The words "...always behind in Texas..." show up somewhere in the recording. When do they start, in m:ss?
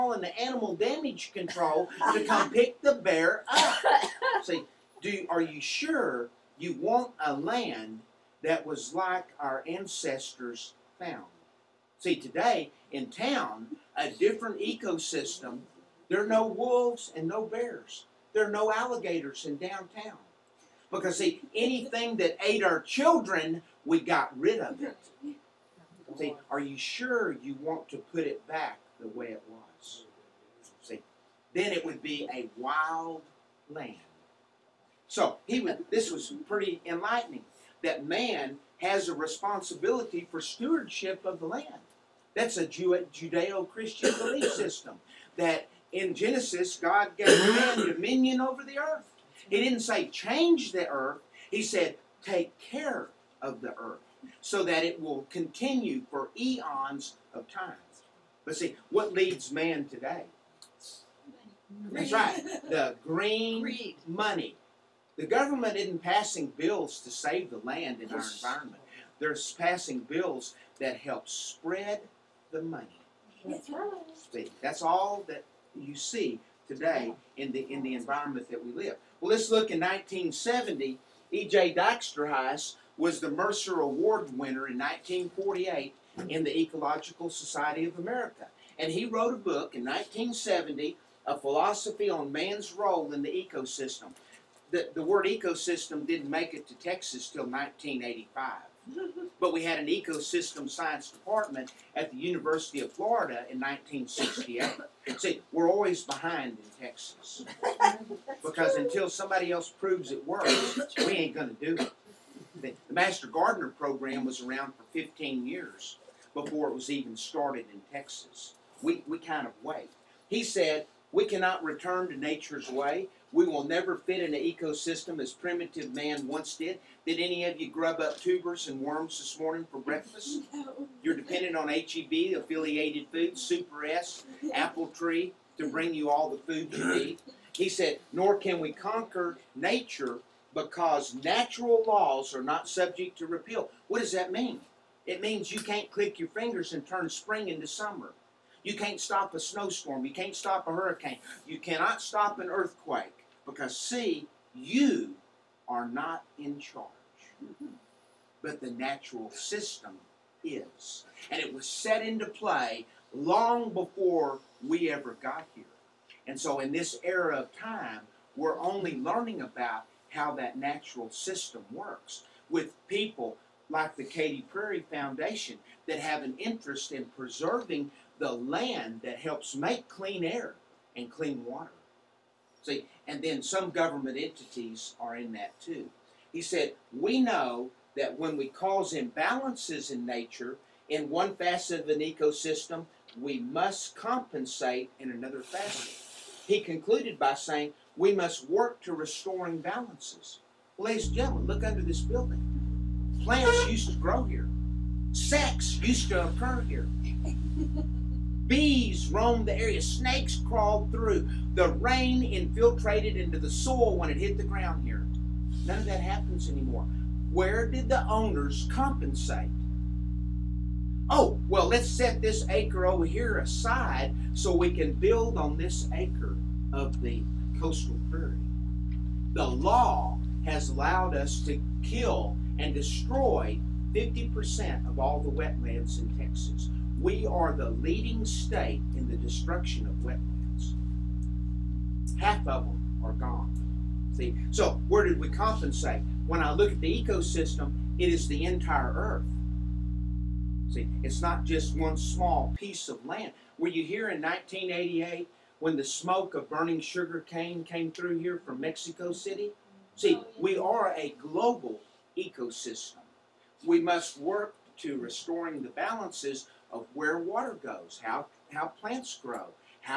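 1:45.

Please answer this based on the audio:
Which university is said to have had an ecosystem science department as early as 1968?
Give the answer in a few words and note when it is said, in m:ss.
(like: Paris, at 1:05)
University of Florida, at 1:42.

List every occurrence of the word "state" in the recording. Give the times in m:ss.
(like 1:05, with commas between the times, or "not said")
3:58.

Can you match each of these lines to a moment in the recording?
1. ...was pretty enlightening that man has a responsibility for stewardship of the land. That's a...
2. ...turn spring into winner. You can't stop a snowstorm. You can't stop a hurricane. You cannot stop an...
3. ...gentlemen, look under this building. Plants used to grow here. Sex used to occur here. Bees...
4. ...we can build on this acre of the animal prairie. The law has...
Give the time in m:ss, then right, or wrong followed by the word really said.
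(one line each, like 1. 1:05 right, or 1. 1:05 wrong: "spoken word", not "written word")
1. 0:36 right
2. 2:26 wrong: "summer", not "winner"
3. 3:21 right
4. 3:44 wrong: "coastal", not "animal".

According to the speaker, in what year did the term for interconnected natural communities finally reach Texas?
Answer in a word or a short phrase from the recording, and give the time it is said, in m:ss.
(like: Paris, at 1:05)
1985, at 1:37.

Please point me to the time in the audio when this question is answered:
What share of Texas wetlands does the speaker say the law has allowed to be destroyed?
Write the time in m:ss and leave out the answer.
3:53.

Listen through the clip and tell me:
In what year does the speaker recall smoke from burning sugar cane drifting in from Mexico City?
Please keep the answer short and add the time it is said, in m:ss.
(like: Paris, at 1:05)
1988, at 4:14.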